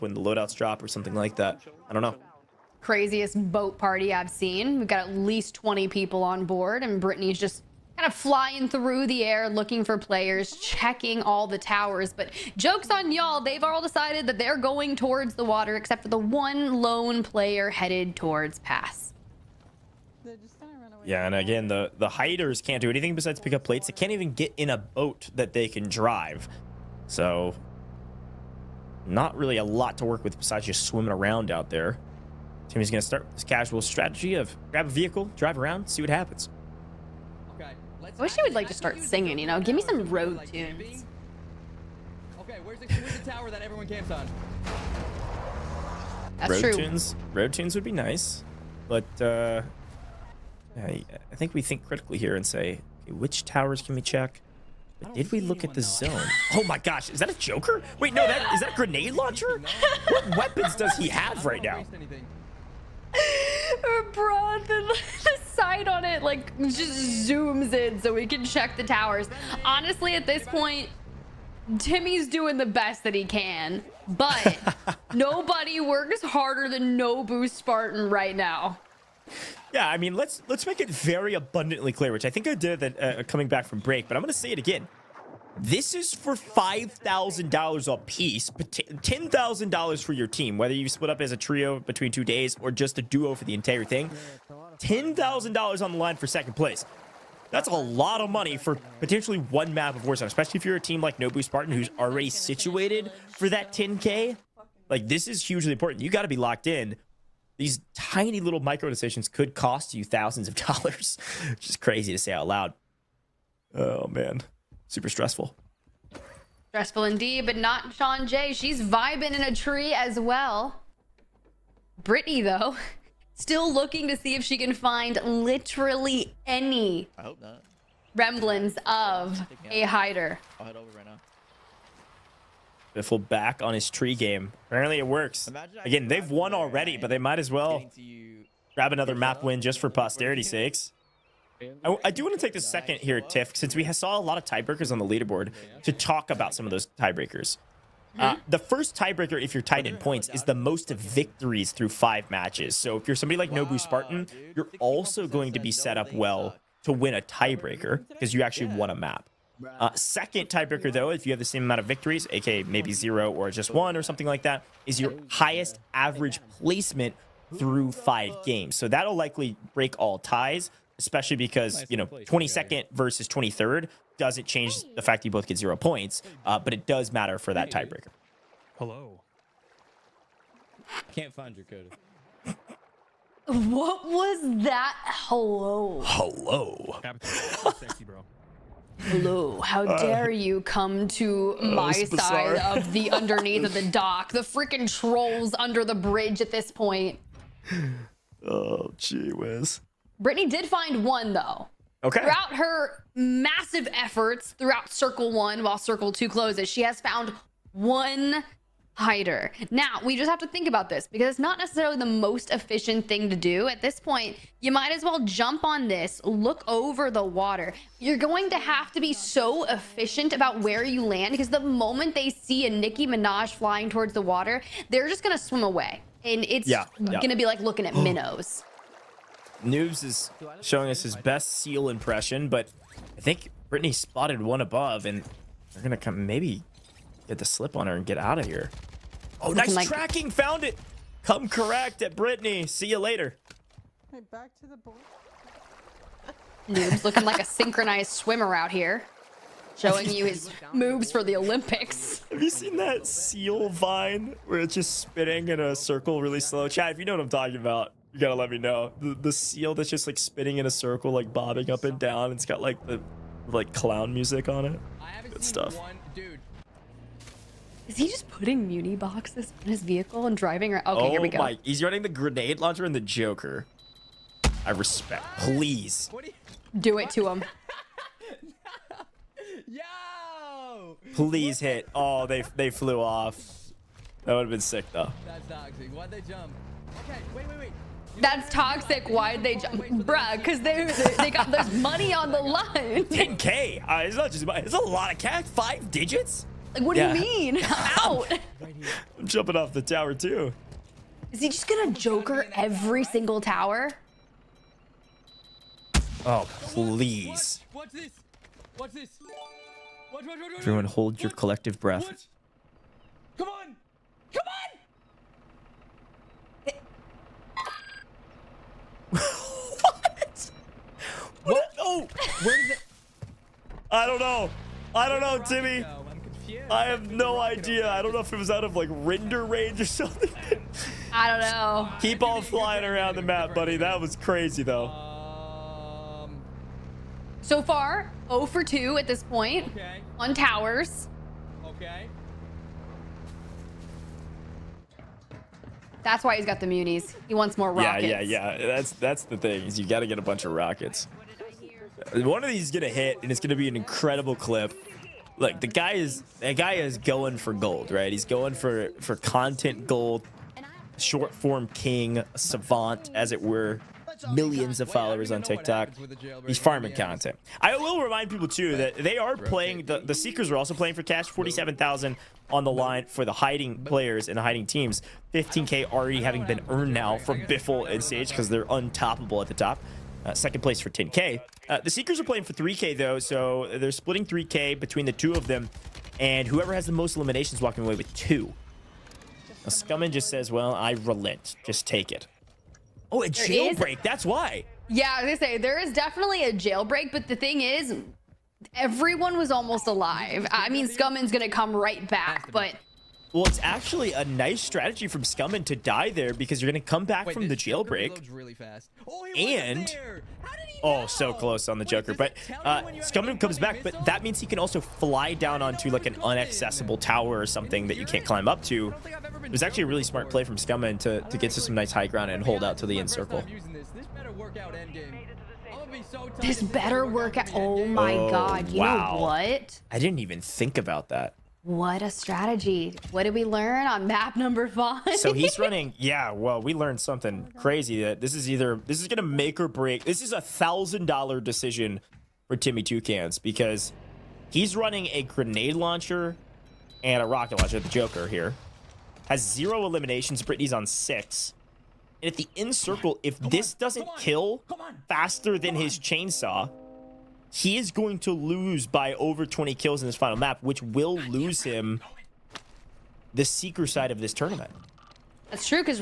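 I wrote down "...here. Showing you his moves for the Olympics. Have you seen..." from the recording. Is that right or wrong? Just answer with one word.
right.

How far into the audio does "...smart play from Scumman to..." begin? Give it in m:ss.
7:00.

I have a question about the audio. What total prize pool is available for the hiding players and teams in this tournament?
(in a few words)
$47,000.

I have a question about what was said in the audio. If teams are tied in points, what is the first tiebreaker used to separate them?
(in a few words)
Most victories.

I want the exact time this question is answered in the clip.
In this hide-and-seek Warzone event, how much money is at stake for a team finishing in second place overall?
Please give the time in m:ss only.
1:34.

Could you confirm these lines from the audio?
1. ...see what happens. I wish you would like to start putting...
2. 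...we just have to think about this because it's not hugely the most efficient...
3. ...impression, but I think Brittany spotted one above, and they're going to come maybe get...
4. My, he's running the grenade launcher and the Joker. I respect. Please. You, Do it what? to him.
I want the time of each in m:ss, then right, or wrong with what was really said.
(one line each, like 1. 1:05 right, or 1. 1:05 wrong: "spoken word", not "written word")
1. 0:35 wrong: "singing", not "putting"
2. 3:30 wrong: "necessarily", not "hugely"
3. 3:51 right
4. 4:31 right.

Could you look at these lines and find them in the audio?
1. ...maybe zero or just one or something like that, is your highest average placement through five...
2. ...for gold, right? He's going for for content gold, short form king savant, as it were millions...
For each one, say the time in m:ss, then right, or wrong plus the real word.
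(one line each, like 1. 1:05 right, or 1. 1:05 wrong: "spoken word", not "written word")
1. 2:42 right
2. 5:57 right.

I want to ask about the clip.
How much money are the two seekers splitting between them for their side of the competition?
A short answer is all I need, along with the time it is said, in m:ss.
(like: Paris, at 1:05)
$3,000, at 6:23.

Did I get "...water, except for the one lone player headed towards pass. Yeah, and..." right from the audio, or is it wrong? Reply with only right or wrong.
right.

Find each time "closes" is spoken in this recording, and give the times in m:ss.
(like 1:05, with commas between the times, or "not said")
3:26, 6:51.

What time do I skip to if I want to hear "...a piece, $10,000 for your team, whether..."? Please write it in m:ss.
1:27.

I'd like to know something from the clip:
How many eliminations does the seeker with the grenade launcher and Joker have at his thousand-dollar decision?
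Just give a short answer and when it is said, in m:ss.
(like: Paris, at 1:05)
0, at 7:29.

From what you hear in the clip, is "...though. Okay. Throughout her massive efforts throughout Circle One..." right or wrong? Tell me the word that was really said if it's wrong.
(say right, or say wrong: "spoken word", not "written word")
right.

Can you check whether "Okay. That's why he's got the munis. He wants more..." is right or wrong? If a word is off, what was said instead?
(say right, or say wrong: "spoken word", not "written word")
right.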